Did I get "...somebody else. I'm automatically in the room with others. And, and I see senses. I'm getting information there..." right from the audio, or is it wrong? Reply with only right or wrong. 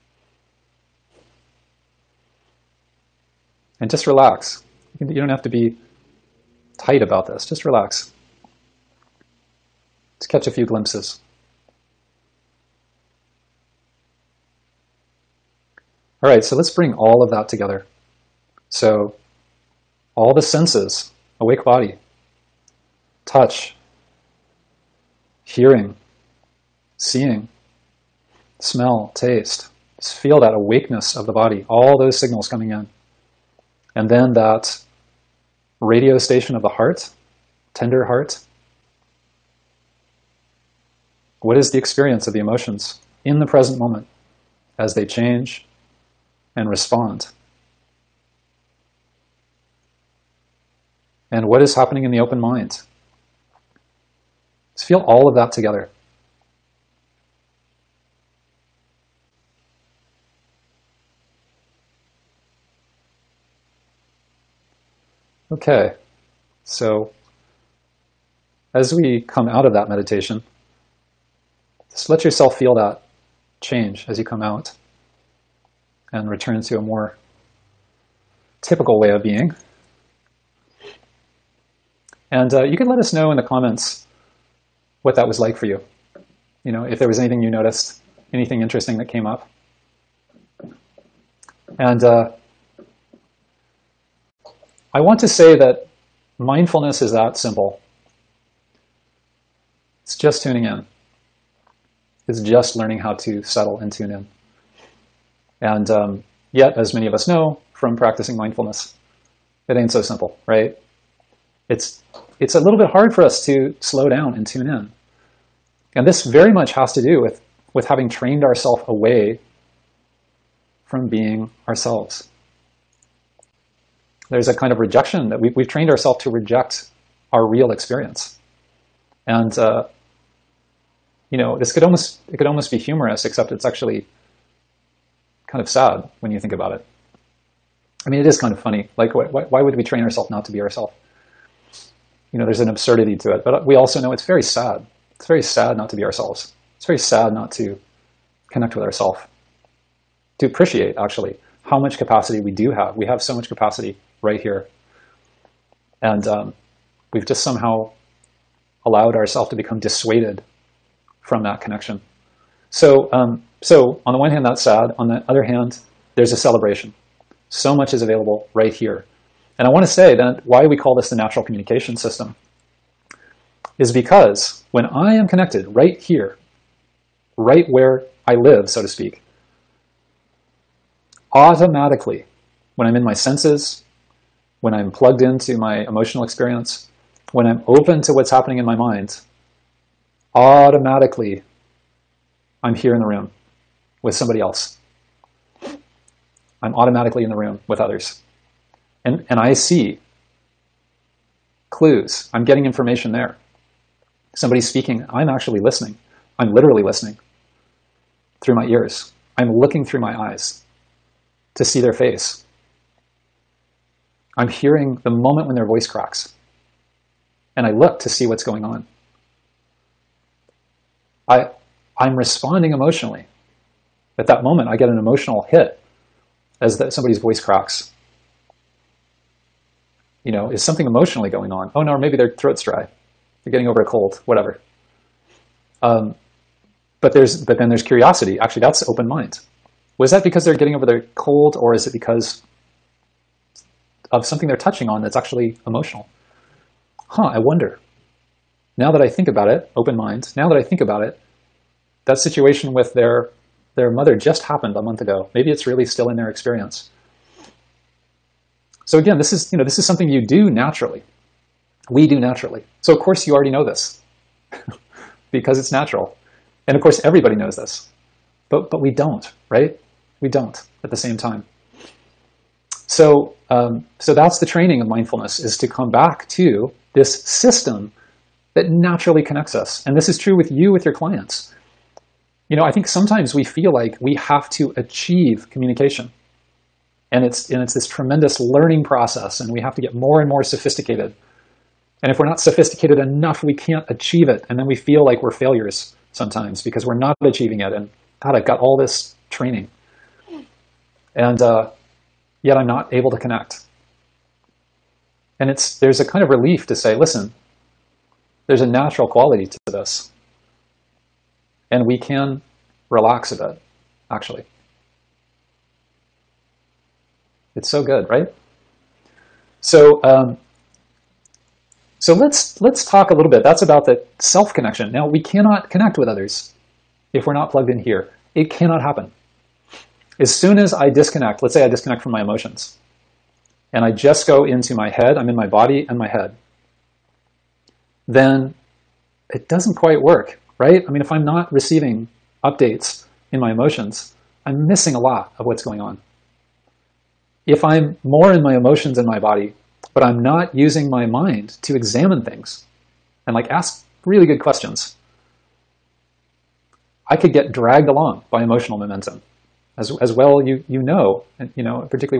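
wrong.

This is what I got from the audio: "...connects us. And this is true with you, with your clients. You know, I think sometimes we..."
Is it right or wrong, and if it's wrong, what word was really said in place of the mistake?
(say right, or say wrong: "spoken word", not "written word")
right.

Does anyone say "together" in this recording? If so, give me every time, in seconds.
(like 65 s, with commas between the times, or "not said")
17 s, 55 s.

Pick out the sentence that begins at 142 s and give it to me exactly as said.
You know, there's an absurdity to it.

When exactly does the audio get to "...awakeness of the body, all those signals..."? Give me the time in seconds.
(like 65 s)
30 s.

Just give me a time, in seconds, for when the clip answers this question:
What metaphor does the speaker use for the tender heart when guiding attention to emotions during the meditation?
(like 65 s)
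35 s.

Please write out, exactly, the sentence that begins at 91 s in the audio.
And uh, I want to say that mindfulness is that simple.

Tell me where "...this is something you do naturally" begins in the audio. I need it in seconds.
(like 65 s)
259 s.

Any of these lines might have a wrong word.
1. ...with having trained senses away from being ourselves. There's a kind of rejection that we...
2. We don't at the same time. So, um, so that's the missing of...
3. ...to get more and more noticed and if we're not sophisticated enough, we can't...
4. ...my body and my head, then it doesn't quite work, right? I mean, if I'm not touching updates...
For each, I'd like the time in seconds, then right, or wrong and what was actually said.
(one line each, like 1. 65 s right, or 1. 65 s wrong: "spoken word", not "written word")
1. 117 s wrong: "ourselves", not "senses"
2. 270 s wrong: "training", not "missing"
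3. 289 s wrong: "sophisticated", not "noticed"
4. 335 s wrong: "receiving", not "touching".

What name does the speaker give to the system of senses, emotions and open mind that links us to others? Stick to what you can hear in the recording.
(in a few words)
natural communication system.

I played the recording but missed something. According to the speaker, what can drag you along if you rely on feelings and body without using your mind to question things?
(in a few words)
emotional momentum.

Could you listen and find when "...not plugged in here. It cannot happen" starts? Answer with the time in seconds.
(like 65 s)
327 s.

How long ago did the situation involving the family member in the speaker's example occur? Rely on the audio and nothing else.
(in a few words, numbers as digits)
a month ago.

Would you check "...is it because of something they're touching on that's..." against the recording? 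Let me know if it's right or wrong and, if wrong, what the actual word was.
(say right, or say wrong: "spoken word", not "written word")
right.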